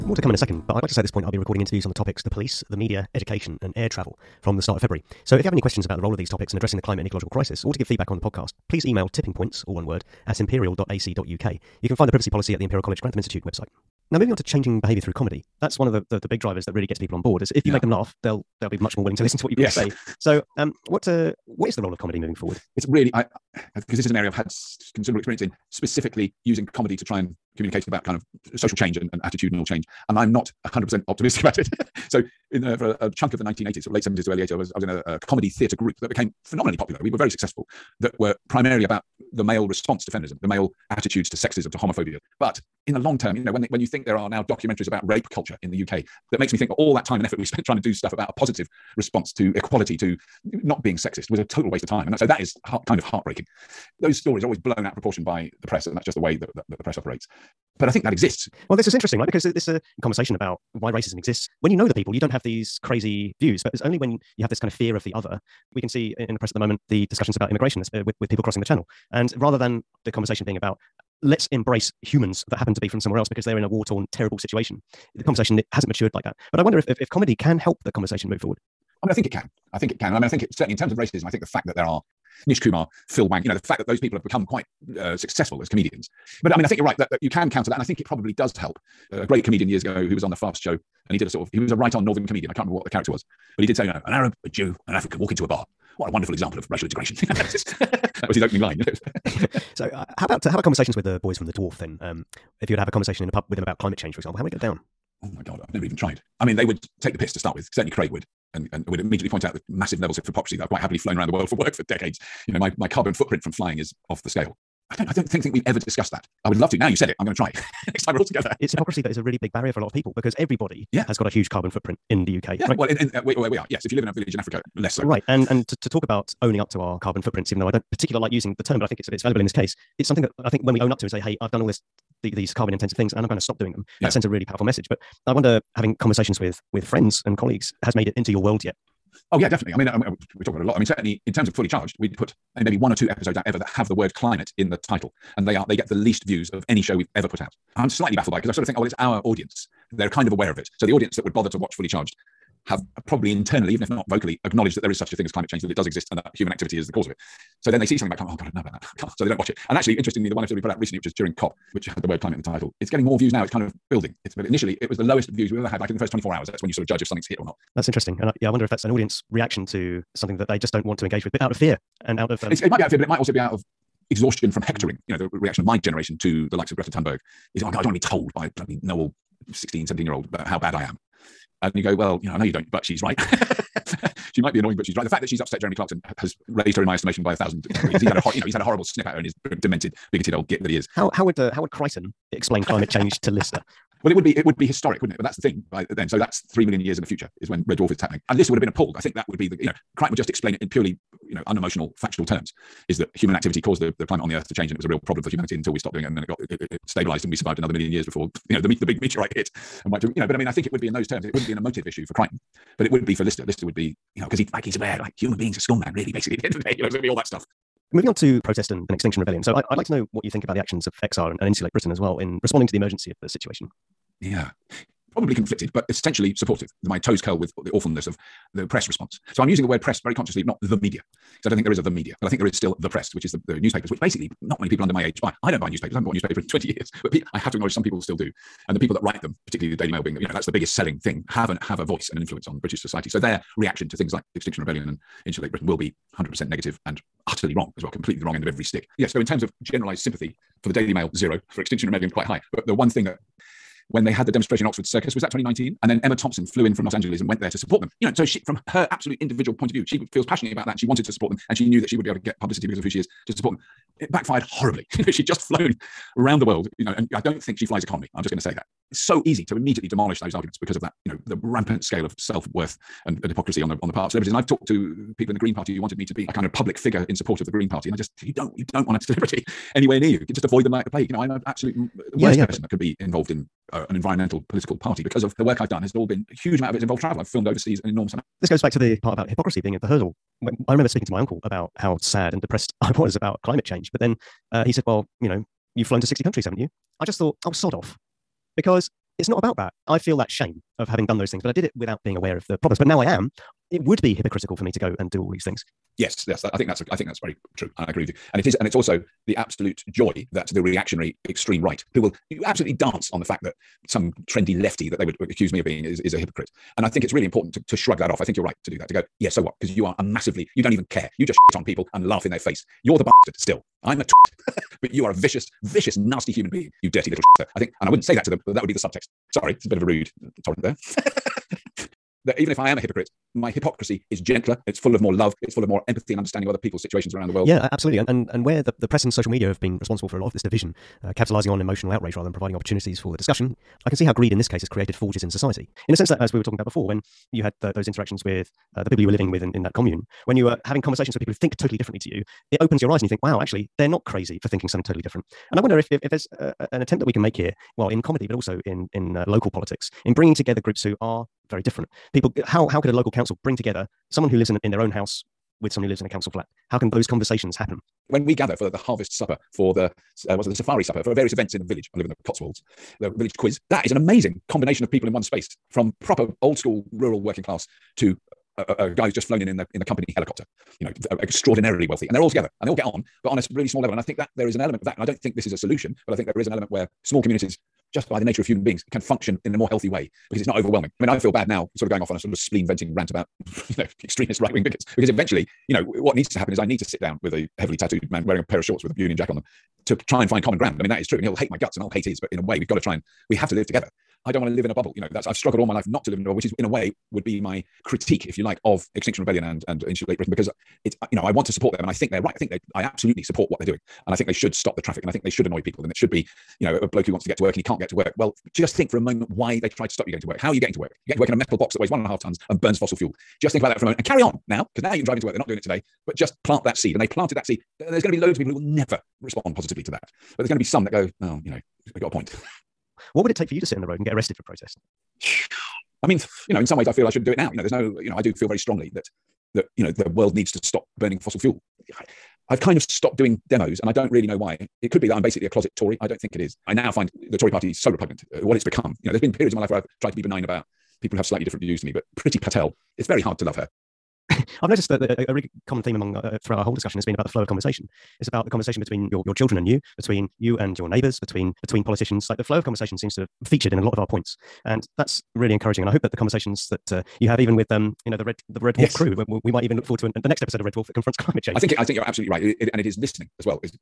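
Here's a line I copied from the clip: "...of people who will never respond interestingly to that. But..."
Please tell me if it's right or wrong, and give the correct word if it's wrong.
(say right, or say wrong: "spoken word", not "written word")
wrong: "positively", not "interestingly".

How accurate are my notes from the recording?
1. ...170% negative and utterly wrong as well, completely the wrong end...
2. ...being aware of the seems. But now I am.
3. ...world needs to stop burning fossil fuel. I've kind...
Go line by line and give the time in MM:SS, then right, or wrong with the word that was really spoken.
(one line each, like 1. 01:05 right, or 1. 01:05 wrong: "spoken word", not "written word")
1. 04:06 wrong: "100", not "170"
2. 05:02 wrong: "problems", not "seems"
3. 07:20 right.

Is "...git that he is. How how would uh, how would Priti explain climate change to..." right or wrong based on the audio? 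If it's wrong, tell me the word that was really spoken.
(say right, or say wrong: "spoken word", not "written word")
wrong: "Kryten", not "Priti".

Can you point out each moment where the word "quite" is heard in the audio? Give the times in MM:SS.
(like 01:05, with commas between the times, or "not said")
01:24, 01:50, 04:12.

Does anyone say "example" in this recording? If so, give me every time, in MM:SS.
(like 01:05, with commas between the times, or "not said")
01:36, 01:44.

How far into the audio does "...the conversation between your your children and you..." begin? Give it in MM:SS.
07:38.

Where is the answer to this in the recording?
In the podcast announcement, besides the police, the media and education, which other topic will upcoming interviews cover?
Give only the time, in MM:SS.
00:03.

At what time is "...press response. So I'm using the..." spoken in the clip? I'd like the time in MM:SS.
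03:48.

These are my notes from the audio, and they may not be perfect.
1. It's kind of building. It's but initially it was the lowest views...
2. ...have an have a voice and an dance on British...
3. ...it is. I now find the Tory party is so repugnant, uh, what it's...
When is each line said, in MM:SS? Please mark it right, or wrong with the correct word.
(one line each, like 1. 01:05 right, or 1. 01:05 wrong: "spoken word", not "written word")
1. 02:43 right
2. 04:01 wrong: "influence", not "dance"
3. 07:26 right.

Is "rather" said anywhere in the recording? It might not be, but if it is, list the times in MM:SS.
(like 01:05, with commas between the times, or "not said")
01:09, 05:42.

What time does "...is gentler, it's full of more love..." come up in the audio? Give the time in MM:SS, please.
05:34.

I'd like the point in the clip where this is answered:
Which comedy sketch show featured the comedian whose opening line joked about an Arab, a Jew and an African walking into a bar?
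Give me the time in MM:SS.
01:30.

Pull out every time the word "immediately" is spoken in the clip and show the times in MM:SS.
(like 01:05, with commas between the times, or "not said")
01:48, 04:29.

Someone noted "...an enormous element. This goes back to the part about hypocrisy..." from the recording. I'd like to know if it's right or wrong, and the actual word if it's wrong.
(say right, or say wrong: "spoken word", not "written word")
wrong: "amount", not "element".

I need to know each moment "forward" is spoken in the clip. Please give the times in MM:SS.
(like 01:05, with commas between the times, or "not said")
00:22, 01:18, 07:49.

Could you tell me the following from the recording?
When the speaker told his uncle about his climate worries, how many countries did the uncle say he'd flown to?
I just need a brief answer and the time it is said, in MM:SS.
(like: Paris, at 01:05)
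60, at 04:56.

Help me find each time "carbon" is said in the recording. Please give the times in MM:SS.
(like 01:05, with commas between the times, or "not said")
01:52, 02:01, 02:07, 02:12.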